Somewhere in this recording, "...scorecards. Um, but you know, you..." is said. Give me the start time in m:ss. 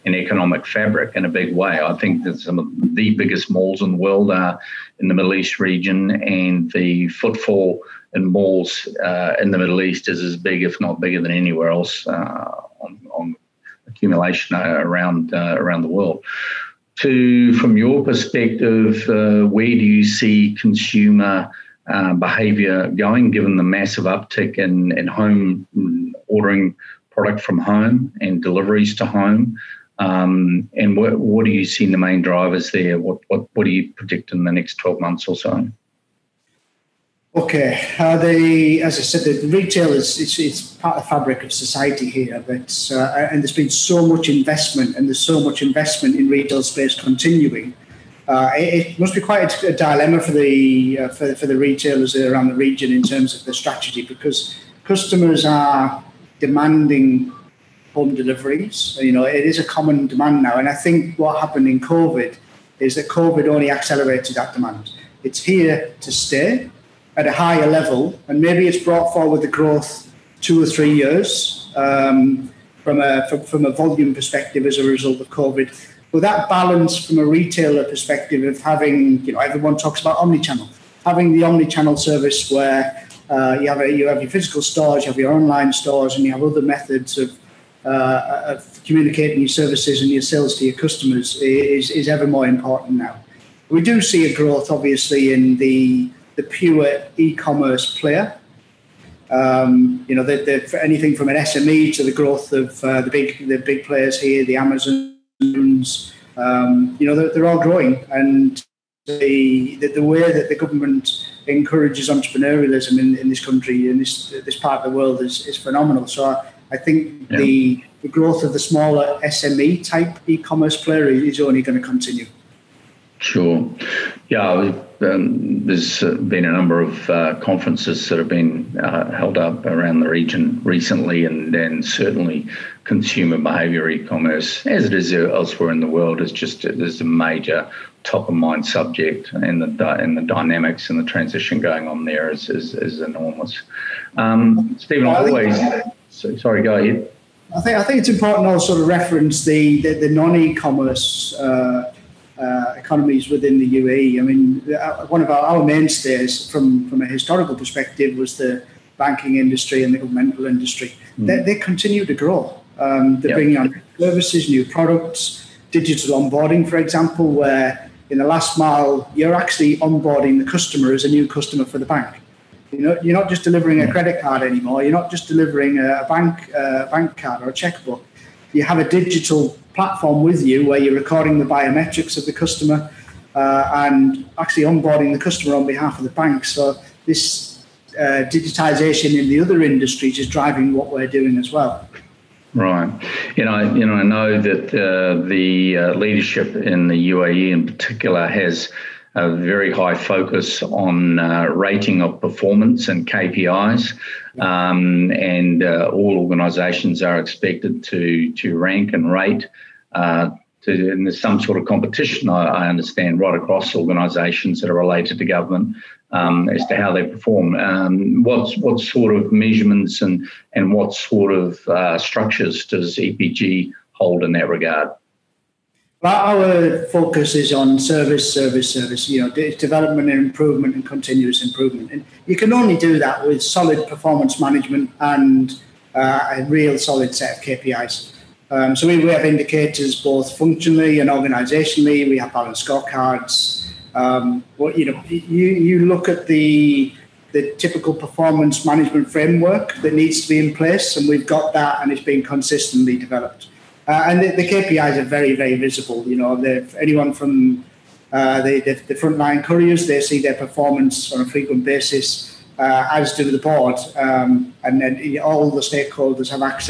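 4:02.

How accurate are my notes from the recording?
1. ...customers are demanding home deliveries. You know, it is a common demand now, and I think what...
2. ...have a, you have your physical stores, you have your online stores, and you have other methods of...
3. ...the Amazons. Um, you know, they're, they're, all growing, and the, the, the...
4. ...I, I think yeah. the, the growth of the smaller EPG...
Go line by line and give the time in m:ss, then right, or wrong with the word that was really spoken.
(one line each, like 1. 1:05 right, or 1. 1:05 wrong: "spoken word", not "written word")
1. 0:54 right
2. 1:23 right
3. 1:44 right
4. 1:56 wrong: "SME", not "EPG".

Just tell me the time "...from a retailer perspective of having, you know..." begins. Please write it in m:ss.
1:17.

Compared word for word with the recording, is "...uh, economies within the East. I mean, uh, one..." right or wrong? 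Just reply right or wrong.
wrong.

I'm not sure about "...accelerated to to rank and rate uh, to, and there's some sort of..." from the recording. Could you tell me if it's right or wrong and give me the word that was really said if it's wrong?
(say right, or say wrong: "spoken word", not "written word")
wrong: "expected", not "accelerated".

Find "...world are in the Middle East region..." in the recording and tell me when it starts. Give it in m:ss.
0:03.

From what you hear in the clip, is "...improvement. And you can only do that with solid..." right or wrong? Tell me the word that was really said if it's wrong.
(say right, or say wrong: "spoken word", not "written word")
right.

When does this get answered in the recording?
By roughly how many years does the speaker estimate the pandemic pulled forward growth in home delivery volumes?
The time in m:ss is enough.
1:10.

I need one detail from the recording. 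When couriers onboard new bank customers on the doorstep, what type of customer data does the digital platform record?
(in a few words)
Biometrics.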